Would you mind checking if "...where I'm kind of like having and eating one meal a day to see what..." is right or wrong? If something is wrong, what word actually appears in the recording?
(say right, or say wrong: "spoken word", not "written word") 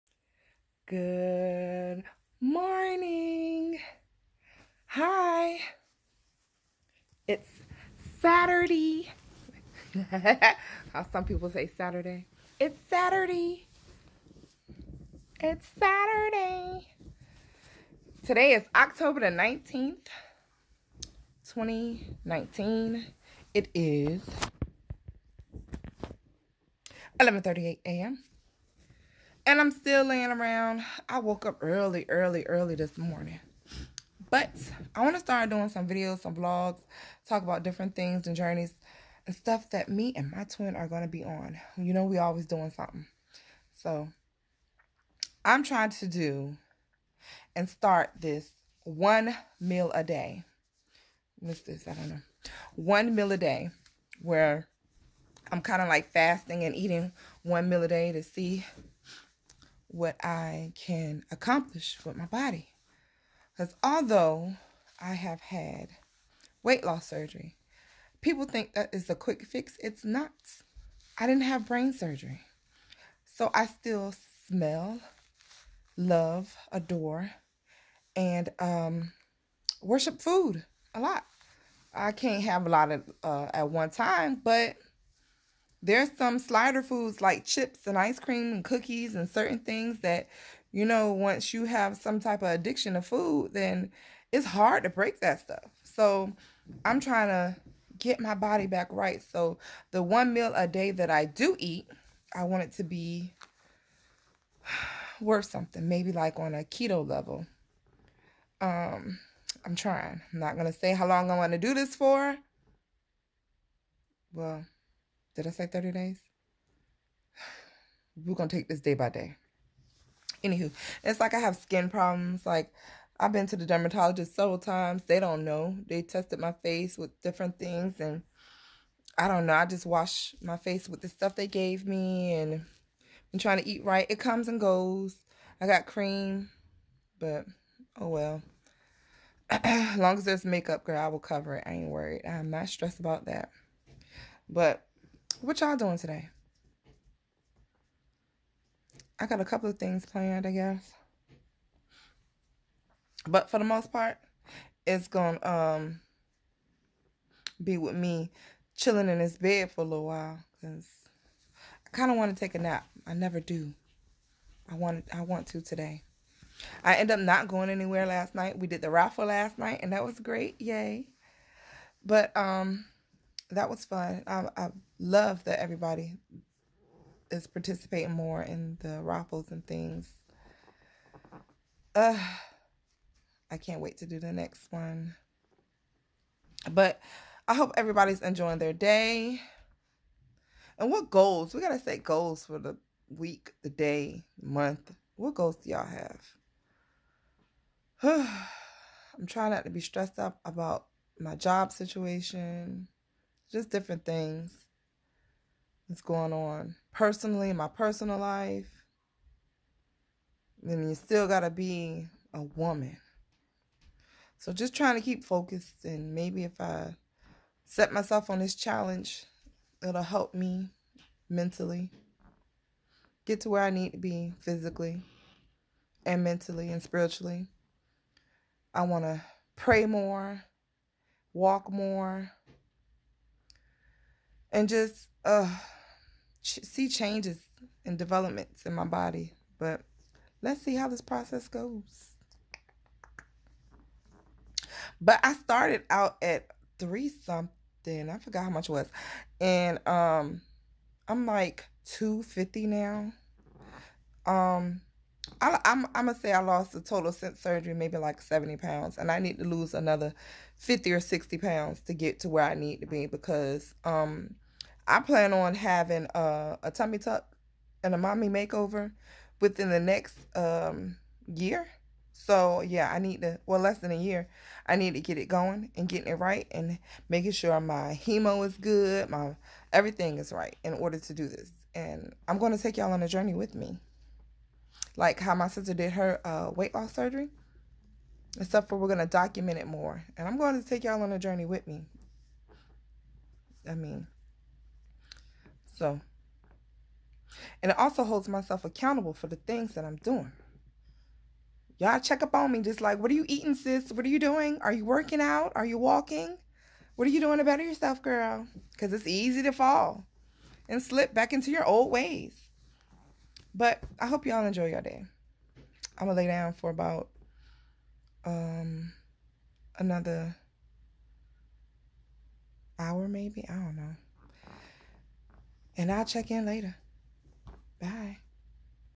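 wrong: "fasting", not "having".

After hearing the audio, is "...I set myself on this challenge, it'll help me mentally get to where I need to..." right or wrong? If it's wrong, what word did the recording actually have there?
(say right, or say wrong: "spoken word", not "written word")
right.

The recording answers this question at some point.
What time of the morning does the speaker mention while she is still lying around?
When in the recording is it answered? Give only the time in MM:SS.
00:27.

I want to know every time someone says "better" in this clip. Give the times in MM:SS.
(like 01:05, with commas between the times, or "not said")
05:07.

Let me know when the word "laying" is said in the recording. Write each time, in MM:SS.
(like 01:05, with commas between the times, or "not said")
00:30.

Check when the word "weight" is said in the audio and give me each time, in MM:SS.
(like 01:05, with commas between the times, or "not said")
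01:06, 04:46.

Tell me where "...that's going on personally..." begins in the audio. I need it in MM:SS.
03:25.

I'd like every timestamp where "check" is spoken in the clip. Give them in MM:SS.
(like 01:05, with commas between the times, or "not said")
05:01, 05:26.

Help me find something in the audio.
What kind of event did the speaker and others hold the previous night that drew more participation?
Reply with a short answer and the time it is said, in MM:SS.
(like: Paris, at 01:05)
raffle, at 02:48.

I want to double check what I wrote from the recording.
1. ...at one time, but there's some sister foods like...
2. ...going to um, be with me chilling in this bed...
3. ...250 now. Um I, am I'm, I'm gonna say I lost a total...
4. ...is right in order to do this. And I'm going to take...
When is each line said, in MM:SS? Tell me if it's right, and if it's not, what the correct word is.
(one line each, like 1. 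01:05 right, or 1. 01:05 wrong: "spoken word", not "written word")
1. 01:23 wrong: "slider", not "sister"
2. 02:35 right
3. 04:11 right
4. 04:40 right.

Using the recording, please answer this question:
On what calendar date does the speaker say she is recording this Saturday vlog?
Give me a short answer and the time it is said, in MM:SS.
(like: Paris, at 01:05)
October 19th, 2019, at 00:18.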